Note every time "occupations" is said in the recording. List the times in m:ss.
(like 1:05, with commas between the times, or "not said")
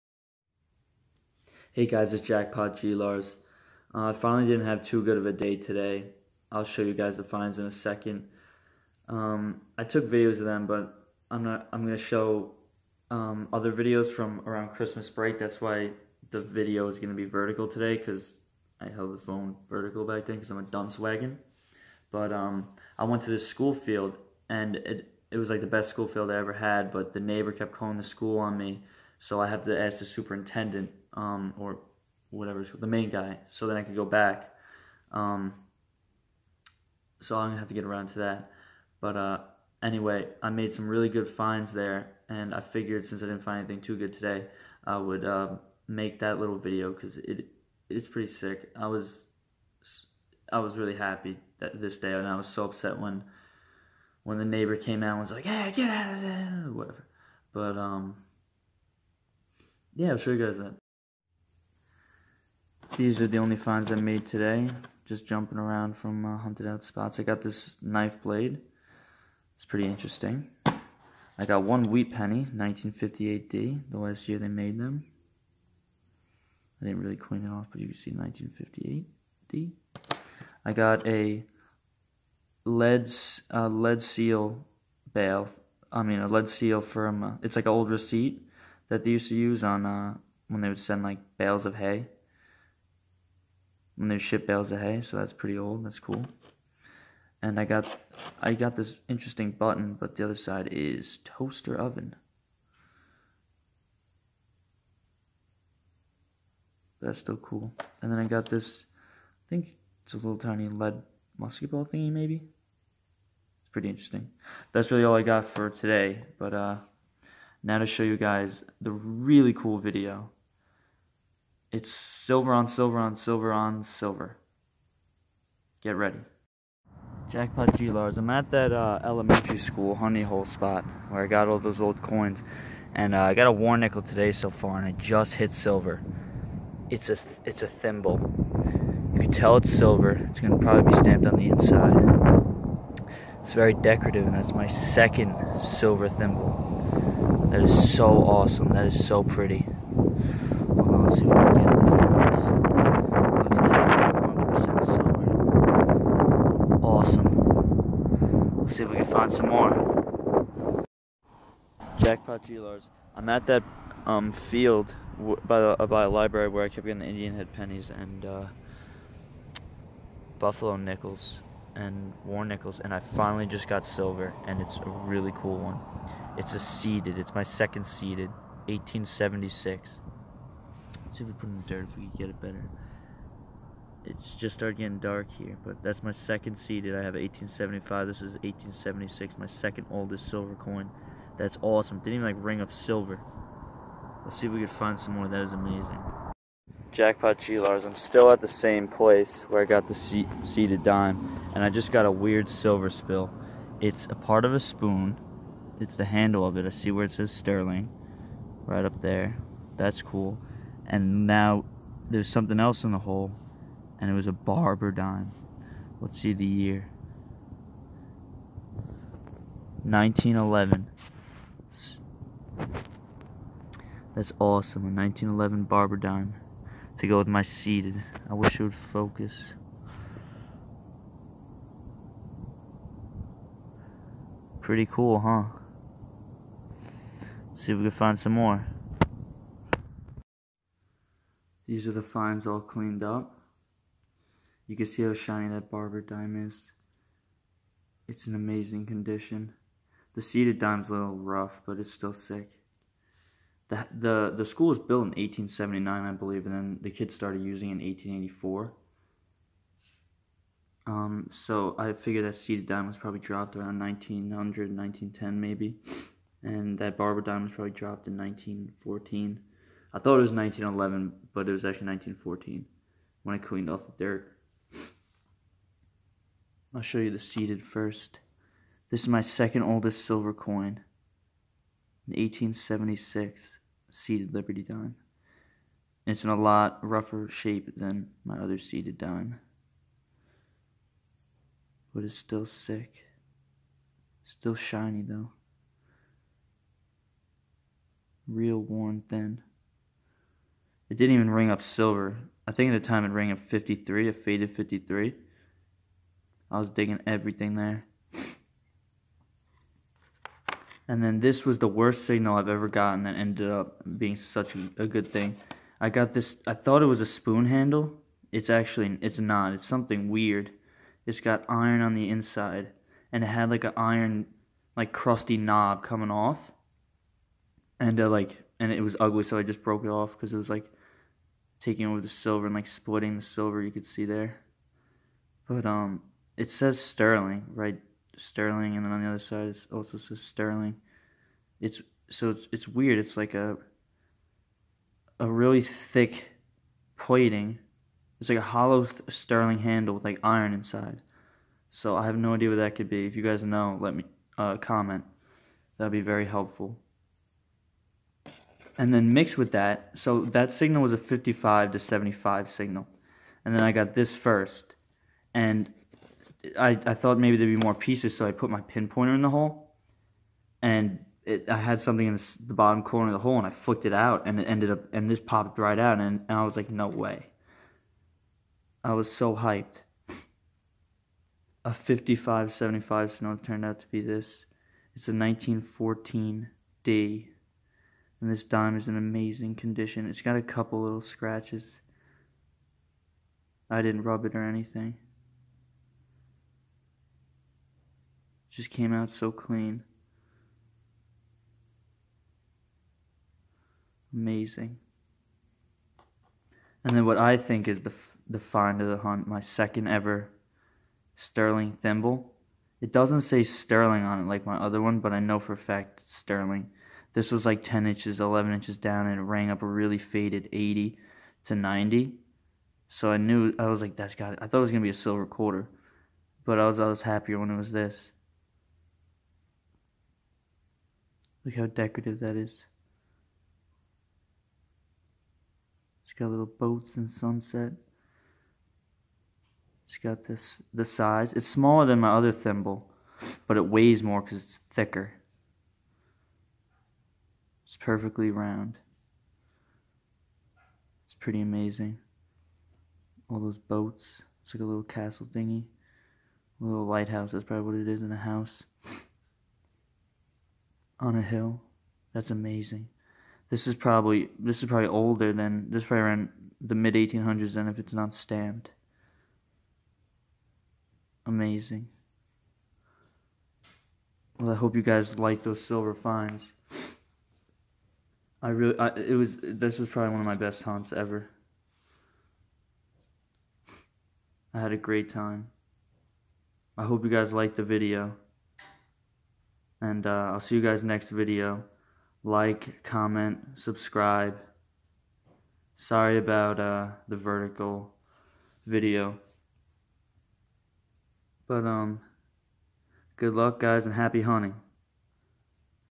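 not said.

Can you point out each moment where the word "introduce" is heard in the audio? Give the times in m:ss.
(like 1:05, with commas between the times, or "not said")
not said.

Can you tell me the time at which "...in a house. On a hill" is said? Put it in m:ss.
7:38.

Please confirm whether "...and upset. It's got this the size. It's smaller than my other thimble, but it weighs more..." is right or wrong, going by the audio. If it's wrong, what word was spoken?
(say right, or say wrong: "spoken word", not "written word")
wrong: "sunset", not "upset".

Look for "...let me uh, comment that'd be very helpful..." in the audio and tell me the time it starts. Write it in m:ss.
5:53.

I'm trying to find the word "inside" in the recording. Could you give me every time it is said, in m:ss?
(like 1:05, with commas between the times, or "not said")
2:21, 5:22, 5:50.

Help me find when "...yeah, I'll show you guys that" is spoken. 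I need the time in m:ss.
0:59.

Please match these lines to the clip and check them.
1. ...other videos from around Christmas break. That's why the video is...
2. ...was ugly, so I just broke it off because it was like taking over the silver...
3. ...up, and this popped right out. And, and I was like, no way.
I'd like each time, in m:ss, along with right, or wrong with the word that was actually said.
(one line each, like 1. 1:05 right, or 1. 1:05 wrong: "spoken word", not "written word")
1. 0:13 right
2. 5:28 right
3. 6:14 right.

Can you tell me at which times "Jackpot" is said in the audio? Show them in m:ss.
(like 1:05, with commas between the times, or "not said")
0:02, 2:07, 2:41, 3:16.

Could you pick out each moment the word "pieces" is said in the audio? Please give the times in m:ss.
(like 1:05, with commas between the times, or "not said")
6:07.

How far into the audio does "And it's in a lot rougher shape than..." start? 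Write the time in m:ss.
4:46.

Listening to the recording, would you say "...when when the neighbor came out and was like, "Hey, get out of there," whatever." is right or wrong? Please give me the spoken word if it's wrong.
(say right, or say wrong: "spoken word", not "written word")
right.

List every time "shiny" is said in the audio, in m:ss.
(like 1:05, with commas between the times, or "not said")
4:05, 4:54.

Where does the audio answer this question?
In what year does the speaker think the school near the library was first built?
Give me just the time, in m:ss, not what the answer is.
4:15.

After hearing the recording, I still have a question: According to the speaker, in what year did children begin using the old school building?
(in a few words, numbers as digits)
1884.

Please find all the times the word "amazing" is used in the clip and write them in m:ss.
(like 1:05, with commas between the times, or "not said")
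3:15, 4:08, 6:28, 6:44, 7:31, 7:42, 7:51.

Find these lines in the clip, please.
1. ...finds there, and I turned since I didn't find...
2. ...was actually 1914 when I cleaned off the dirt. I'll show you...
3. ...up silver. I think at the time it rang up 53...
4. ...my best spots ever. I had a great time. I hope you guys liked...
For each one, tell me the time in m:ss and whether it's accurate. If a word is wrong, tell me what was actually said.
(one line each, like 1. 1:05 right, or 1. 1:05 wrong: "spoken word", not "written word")
1. 0:41 wrong: "figured", not "turned"
2. 4:31 right
3. 5:01 right
4. 8:00 wrong: "hunts", not "spots".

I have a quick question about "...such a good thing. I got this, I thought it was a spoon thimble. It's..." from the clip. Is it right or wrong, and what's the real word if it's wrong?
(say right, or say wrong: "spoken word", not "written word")
wrong: "handle", not "thimble".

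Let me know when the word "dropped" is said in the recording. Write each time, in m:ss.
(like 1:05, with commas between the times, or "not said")
4:23, 4:27.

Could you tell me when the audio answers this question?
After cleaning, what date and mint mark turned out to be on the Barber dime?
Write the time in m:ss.
6:25.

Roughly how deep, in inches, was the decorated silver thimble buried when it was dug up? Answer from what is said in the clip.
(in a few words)
10 to 11 inches.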